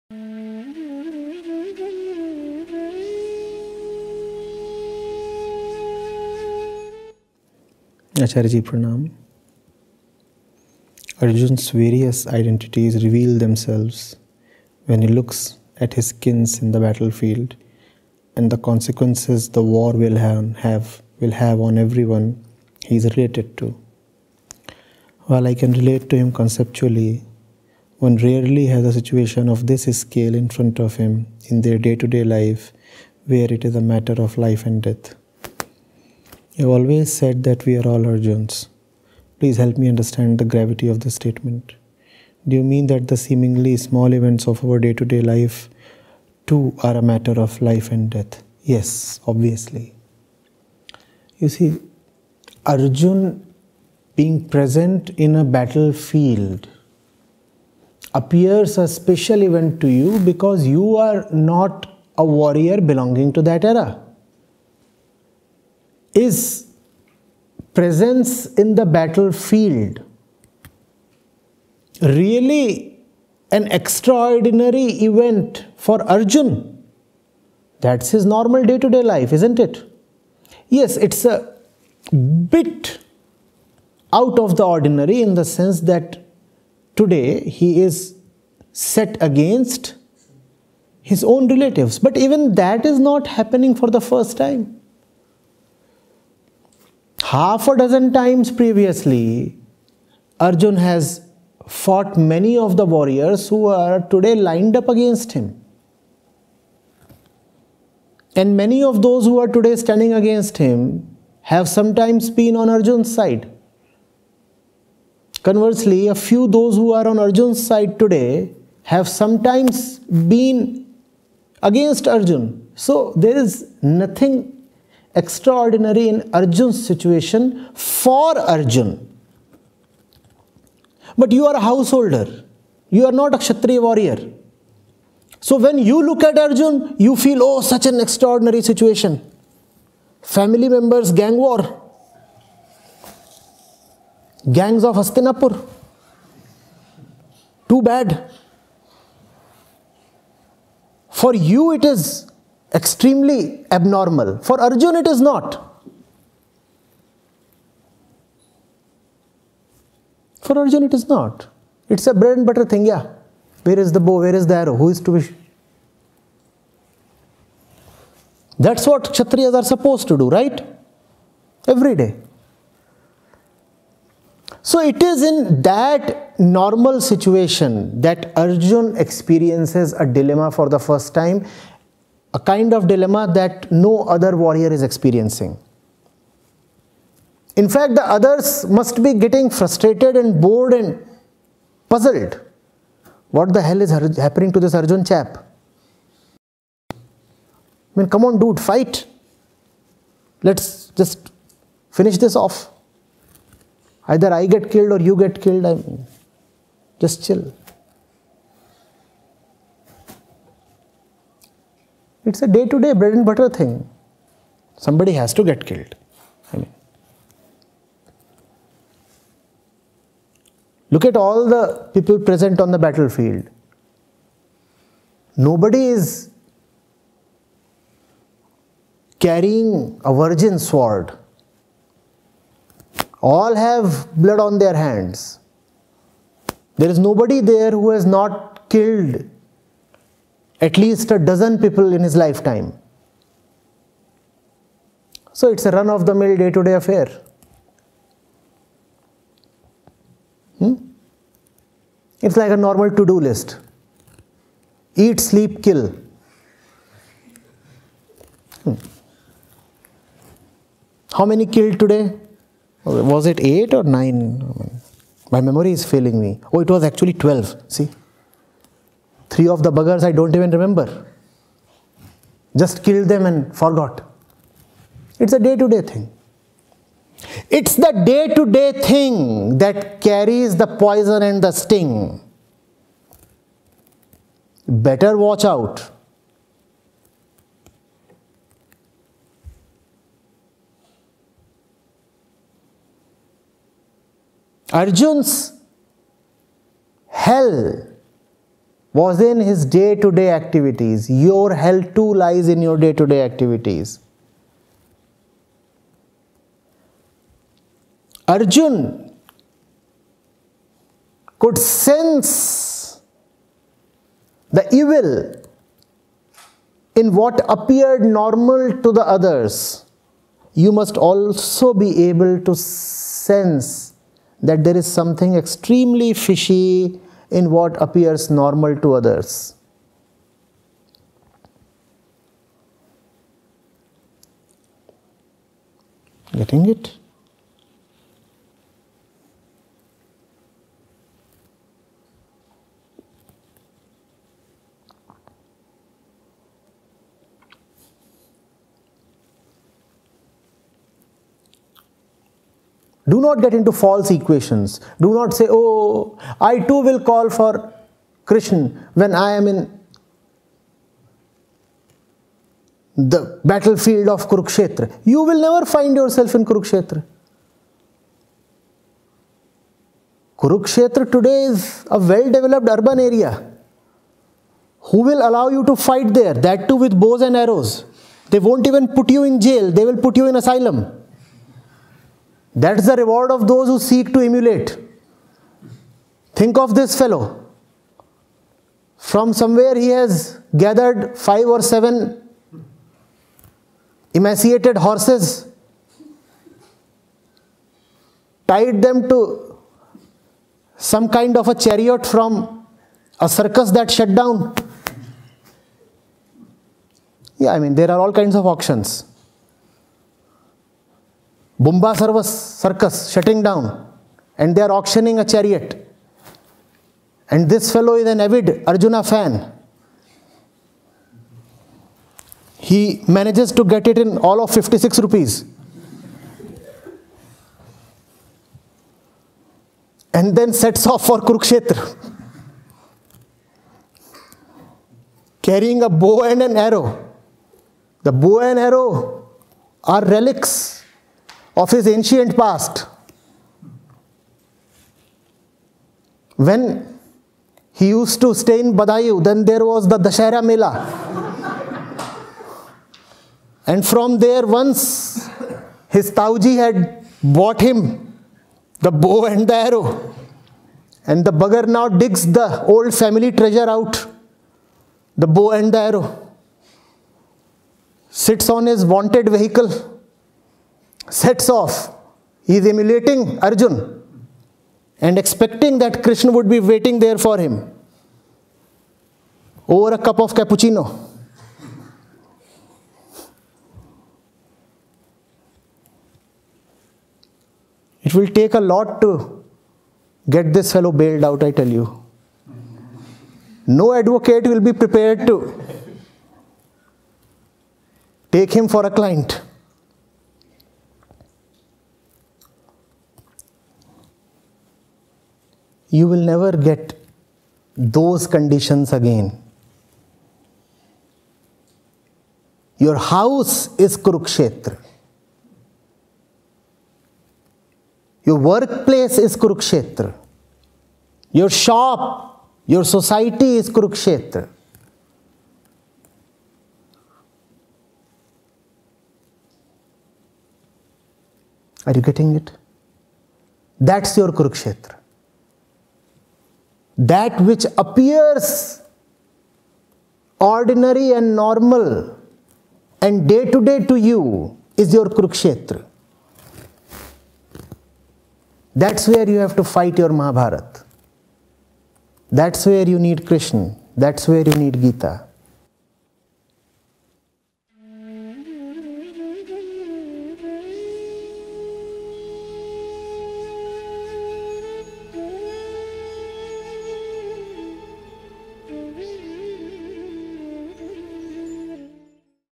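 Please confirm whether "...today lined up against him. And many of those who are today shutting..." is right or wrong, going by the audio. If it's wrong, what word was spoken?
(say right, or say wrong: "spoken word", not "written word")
wrong: "standing", not "shutting".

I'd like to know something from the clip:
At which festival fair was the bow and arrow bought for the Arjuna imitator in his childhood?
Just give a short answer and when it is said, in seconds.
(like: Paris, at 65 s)
Dashara Mela, at 449 s.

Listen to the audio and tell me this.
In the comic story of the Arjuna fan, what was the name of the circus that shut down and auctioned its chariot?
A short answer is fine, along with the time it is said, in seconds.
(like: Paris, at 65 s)
Bumba circus, at 411 s.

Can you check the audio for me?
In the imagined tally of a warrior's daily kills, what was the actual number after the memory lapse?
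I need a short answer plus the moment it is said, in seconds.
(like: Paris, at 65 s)
12, at 267 s.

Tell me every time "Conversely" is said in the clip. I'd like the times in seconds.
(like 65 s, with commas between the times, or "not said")
115 s.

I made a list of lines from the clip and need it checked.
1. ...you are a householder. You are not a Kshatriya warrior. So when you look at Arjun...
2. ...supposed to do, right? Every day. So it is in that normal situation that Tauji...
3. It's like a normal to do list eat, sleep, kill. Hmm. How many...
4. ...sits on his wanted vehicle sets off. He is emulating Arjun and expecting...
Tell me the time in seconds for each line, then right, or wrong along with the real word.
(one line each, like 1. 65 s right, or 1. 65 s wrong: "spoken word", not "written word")
1. 131 s right
2. 169 s wrong: "Arjun", not "Tauji"
3. 252 s right
4. 468 s right.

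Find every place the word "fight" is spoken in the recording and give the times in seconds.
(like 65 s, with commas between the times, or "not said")
198 s, 375 s, 549 s.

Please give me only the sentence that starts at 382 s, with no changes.
That's the reward of those who seek to emulate.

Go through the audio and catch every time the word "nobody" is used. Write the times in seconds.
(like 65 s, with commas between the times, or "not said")
225 s, 237 s.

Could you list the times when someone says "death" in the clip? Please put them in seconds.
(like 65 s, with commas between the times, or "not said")
34 s, 48 s.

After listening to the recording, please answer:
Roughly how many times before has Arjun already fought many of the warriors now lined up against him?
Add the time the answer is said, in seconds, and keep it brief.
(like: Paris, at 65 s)
half a dozen, at 97 s.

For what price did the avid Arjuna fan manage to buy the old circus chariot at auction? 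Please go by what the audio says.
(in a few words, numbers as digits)
56 rupees.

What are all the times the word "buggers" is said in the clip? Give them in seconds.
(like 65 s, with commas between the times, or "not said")
269 s, 461 s.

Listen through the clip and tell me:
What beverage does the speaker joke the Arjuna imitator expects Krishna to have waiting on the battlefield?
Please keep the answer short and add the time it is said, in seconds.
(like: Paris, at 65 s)
cappuccino, at 480 s.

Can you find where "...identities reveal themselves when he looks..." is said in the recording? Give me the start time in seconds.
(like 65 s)
12 s.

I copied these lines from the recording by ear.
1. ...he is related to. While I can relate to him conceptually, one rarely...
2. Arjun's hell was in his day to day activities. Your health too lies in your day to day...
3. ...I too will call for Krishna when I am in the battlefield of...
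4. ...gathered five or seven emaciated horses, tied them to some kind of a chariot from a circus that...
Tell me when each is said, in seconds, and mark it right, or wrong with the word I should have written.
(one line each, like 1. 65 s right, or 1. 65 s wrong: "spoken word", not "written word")
1. 22 s right
2. 294 s right
3. 356 s right
4. 390 s right.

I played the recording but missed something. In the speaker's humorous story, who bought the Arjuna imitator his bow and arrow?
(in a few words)
Tauji.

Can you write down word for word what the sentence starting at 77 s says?
That's his normal day to day life, isn't it?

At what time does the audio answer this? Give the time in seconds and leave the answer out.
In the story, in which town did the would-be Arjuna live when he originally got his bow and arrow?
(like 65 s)
448 s.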